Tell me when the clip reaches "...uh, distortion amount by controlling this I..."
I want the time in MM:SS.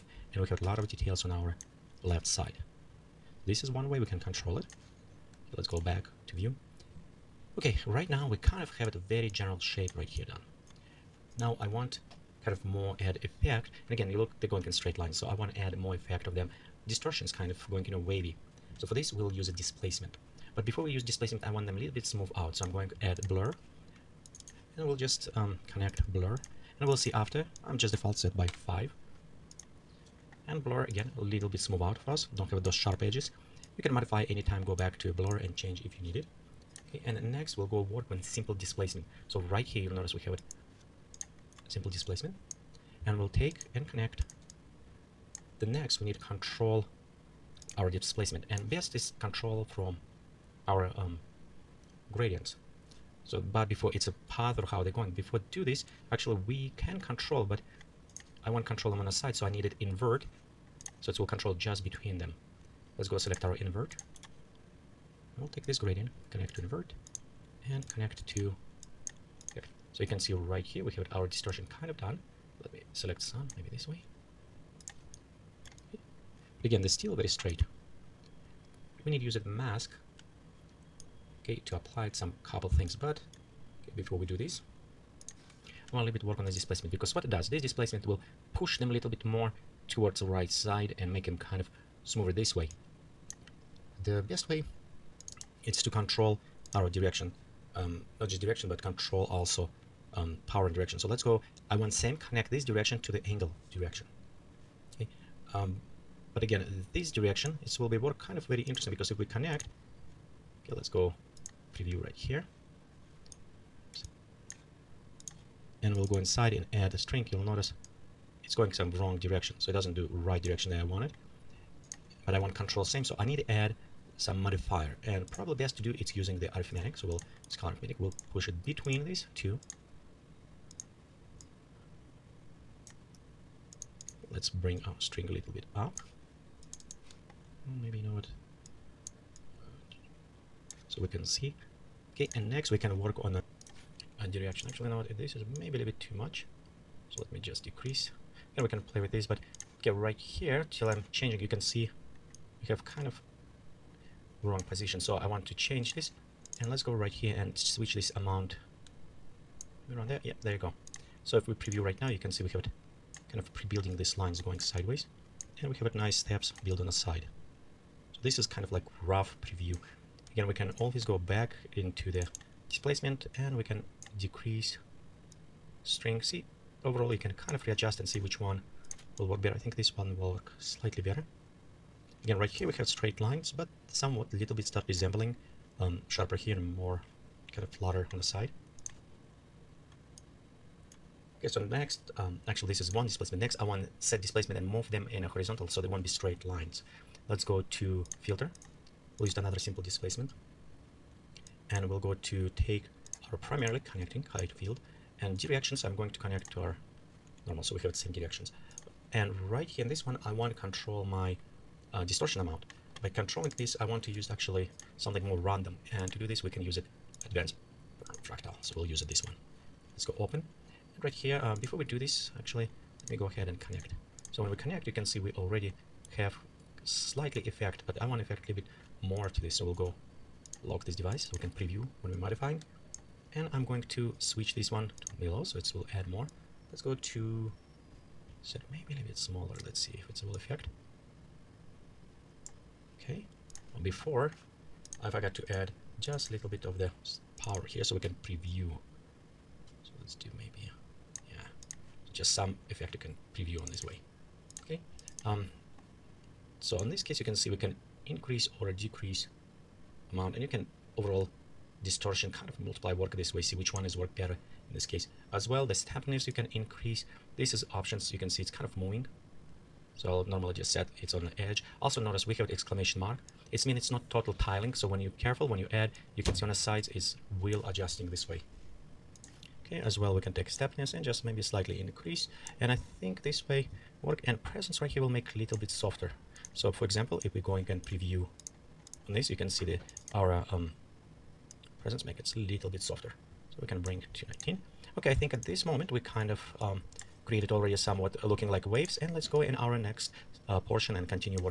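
03:31.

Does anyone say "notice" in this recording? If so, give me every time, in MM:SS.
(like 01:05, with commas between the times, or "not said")
00:39, 01:57, 04:31.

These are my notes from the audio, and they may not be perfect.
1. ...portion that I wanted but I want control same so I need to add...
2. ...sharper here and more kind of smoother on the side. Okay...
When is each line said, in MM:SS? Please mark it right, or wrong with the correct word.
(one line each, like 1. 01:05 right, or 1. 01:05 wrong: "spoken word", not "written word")
1. 02:00 wrong: "direction", not "portion"
2. 03:06 wrong: "flatter", not "smoother".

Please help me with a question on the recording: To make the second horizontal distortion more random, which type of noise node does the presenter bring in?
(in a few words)
advanced fractal.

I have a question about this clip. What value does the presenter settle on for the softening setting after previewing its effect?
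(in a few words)
19.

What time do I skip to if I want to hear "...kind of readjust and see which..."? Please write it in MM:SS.
02:57.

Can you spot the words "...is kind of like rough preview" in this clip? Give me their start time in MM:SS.
02:48.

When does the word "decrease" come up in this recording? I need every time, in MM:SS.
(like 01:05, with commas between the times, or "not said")
02:27, 02:54, 04:18.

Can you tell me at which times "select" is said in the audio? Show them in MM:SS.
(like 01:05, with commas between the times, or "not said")
01:03, 01:12.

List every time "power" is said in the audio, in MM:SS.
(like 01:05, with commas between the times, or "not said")
01:40, 04:07.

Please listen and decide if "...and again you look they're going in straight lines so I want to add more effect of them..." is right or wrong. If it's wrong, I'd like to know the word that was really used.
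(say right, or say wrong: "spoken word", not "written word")
right.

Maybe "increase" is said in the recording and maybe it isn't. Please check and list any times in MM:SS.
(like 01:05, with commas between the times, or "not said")
04:18, 04:26, 04:41.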